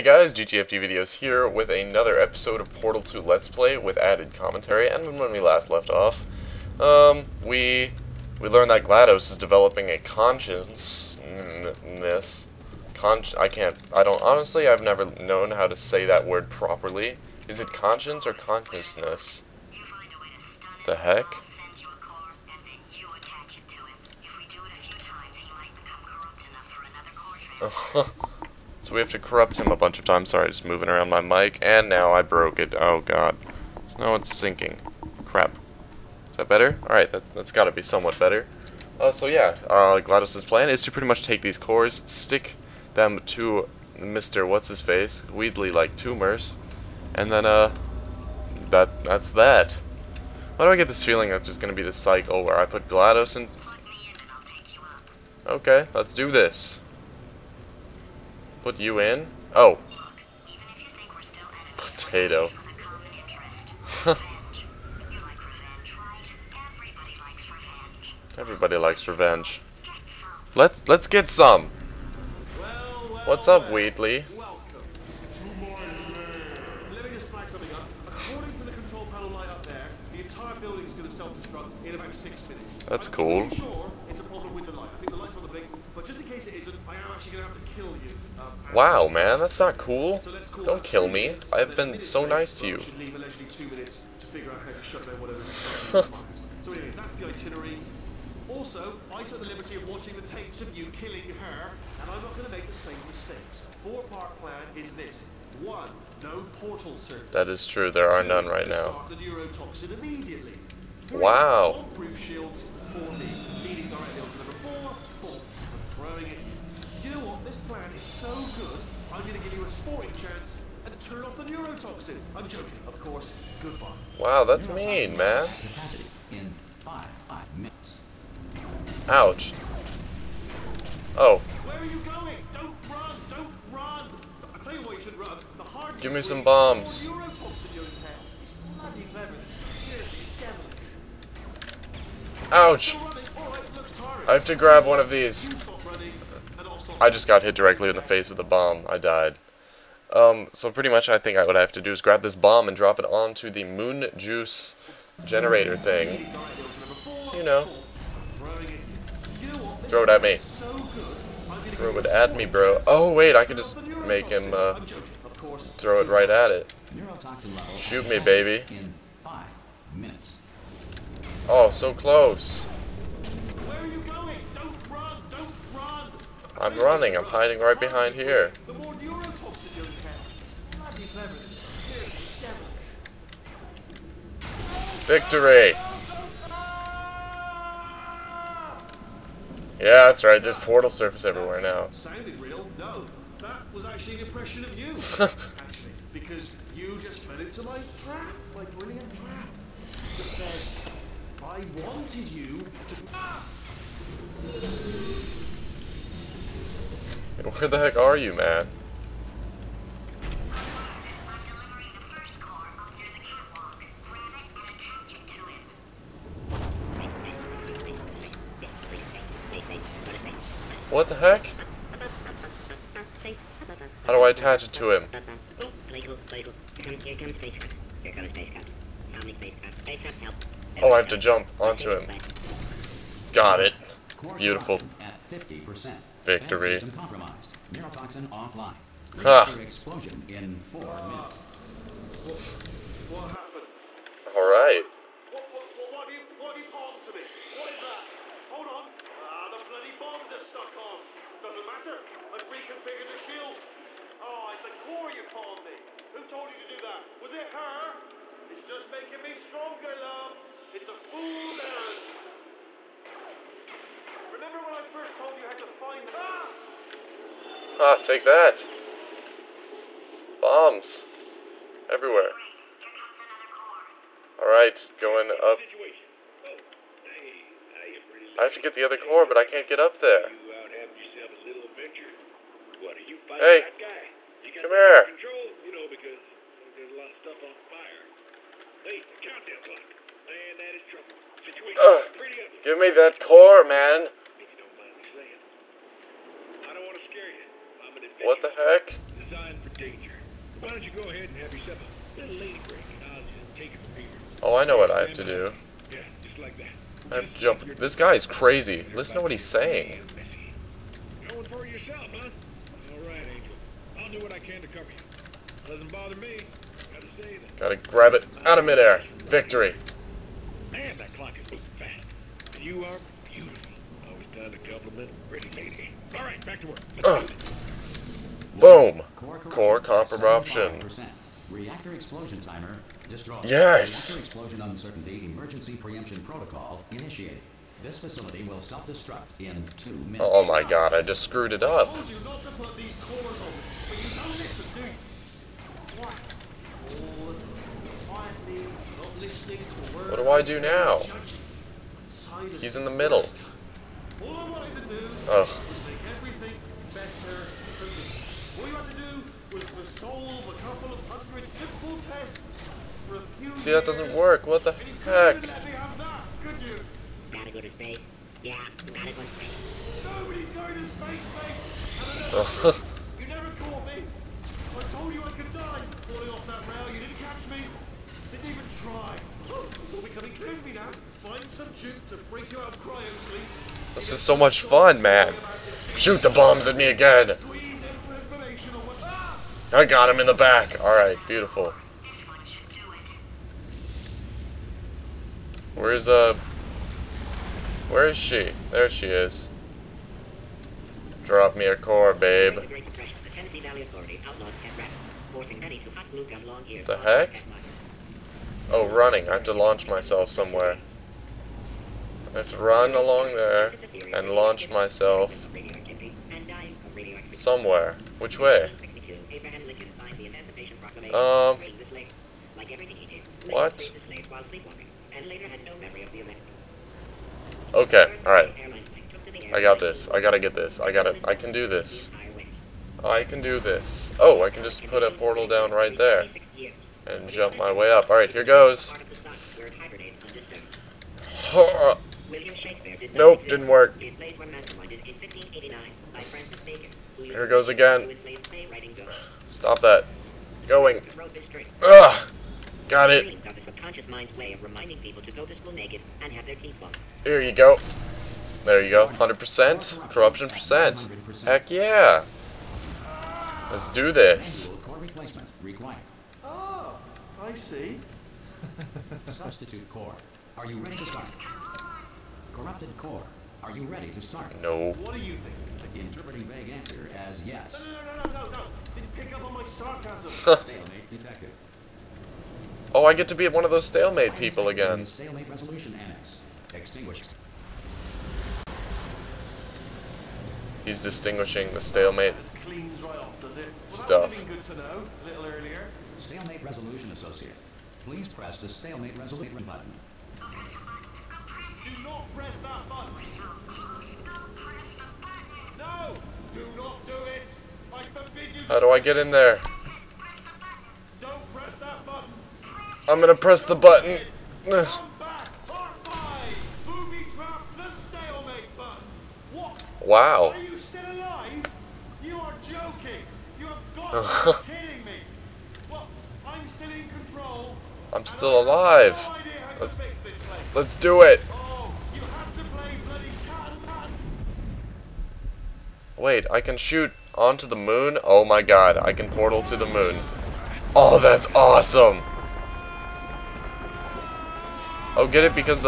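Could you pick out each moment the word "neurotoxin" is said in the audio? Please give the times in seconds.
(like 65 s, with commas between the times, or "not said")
121 s.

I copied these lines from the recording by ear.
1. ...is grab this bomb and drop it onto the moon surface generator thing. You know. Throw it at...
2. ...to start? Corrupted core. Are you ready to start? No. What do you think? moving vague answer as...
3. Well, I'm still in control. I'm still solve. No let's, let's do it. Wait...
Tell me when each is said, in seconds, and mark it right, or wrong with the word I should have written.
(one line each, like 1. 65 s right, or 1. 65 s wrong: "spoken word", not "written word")
1. 151 s wrong: "juice", not "surface"
2. 470 s wrong: "interpreting", not "moving"
3. 525 s wrong: "alive", not "solve".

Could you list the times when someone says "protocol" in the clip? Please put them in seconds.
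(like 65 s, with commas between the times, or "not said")
336 s.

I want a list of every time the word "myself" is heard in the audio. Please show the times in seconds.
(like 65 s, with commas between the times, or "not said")
409 s, 414 s.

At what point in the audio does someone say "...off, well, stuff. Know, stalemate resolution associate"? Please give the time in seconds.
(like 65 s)
493 s.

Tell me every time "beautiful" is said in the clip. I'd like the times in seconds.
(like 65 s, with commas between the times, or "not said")
323 s, 391 s.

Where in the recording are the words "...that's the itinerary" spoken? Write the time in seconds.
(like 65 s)
96 s.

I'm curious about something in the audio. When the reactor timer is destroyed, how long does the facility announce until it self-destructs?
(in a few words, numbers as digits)
2 minutes.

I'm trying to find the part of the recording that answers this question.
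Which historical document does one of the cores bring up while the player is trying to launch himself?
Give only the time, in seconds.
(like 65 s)
420 s.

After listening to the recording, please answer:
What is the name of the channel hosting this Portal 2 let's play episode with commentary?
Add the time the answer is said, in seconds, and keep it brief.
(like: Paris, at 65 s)
GTFD Videos, at 0 s.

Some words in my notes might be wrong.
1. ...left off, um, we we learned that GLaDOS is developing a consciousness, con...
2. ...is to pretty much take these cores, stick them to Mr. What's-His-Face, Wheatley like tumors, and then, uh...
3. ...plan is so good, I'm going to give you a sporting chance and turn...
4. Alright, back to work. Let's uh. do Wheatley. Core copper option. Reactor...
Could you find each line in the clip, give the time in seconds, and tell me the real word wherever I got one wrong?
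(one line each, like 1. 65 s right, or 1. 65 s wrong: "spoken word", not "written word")
1. 5 s right
2. 40 s right
3. 117 s right
4. 326 s wrong: "Boom", not "Wheatley".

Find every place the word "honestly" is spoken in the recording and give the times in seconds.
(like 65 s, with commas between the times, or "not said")
14 s.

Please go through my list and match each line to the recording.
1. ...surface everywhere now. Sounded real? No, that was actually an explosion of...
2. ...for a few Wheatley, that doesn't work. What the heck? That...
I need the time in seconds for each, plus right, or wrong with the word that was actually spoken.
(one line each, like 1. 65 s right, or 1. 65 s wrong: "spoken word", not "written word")
1. 190 s wrong: "impression", not "explosion"
2. 363 s wrong: "See", not "Wheatley".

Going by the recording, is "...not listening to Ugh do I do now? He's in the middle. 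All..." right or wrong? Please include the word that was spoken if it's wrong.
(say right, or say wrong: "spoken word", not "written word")
wrong: "What", not "Ugh".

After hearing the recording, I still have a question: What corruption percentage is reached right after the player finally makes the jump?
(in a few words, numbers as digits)
100%.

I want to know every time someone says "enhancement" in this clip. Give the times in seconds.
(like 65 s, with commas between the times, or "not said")
not said.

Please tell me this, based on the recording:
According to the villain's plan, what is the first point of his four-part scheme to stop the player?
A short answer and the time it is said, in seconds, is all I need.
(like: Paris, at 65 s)
No portal service, at 106 s.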